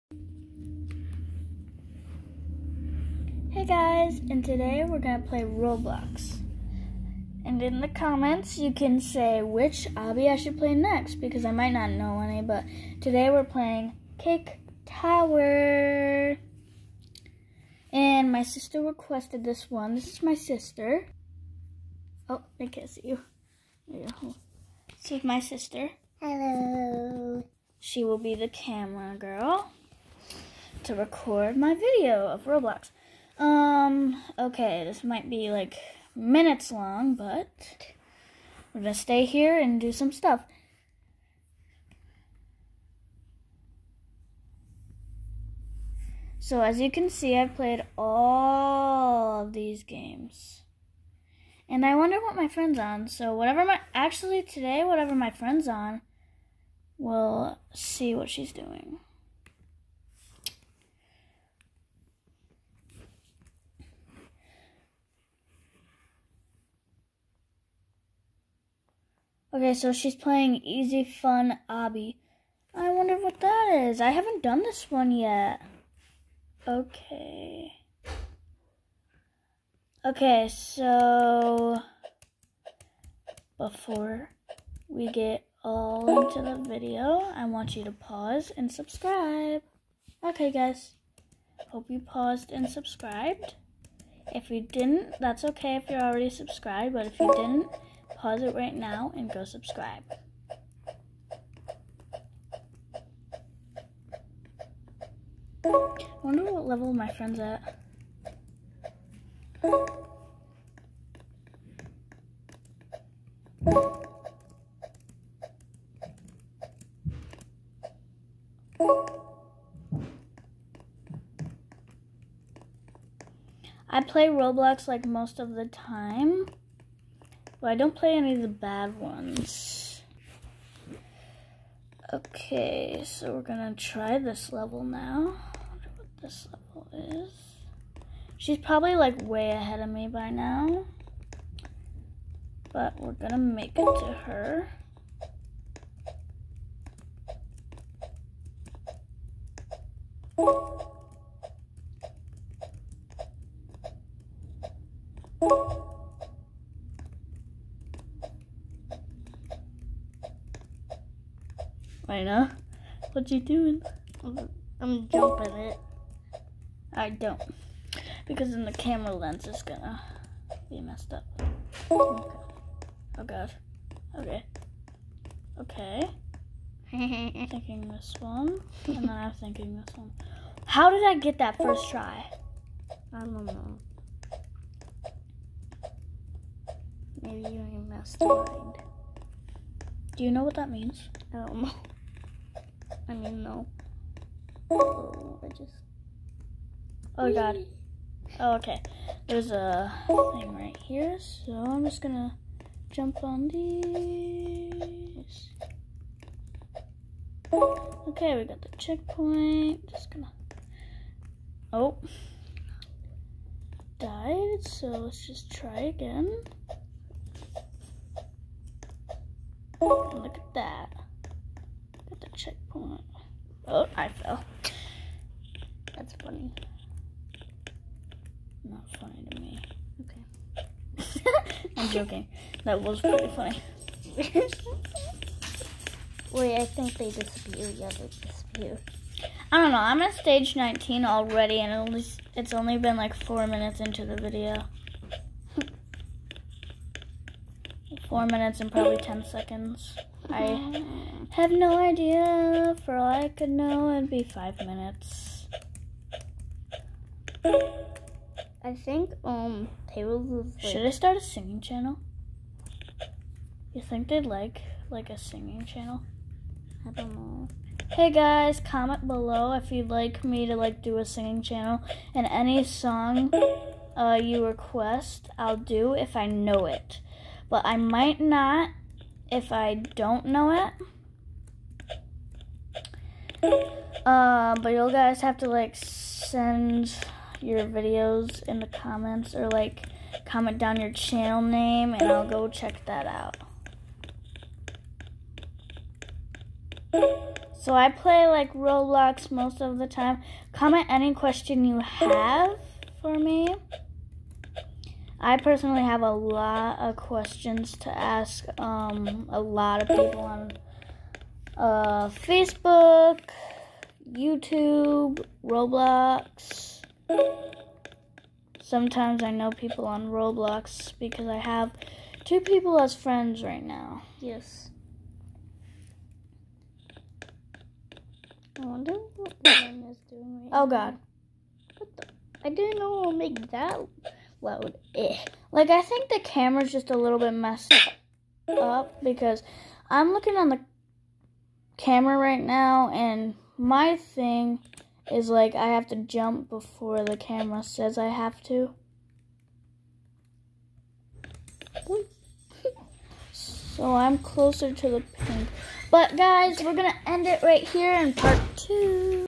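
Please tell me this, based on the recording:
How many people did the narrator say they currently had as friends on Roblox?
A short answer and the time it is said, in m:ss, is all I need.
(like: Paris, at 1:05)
2, at 5:22.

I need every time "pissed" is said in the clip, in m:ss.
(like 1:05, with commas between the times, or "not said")
not said.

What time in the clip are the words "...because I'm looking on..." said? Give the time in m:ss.
5:39.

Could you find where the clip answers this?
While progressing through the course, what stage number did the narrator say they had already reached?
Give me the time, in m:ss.
4:00.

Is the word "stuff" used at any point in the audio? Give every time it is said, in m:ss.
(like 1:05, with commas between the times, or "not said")
0:40.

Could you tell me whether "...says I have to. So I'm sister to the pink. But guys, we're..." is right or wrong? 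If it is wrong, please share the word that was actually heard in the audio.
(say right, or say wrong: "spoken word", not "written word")
wrong: "closer", not "sister".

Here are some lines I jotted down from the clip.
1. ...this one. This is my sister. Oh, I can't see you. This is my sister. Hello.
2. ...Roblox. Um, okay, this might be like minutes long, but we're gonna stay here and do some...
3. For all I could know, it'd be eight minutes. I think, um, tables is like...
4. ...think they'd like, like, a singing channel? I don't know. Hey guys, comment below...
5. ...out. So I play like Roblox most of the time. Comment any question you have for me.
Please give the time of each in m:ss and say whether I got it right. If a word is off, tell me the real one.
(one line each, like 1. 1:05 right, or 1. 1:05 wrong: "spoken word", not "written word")
1. 0:19 right
2. 0:32 right
3. 4:12 wrong: "five", not "eight"
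4. 4:23 right
5. 4:53 right.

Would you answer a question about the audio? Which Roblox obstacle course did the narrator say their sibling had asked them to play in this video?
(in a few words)
Cake Tower.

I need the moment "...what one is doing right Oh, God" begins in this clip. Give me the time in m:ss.
5:29.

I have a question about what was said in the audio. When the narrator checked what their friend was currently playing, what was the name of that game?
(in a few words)
Easy Fun Obby.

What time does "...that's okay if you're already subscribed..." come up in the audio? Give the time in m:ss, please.
1:35.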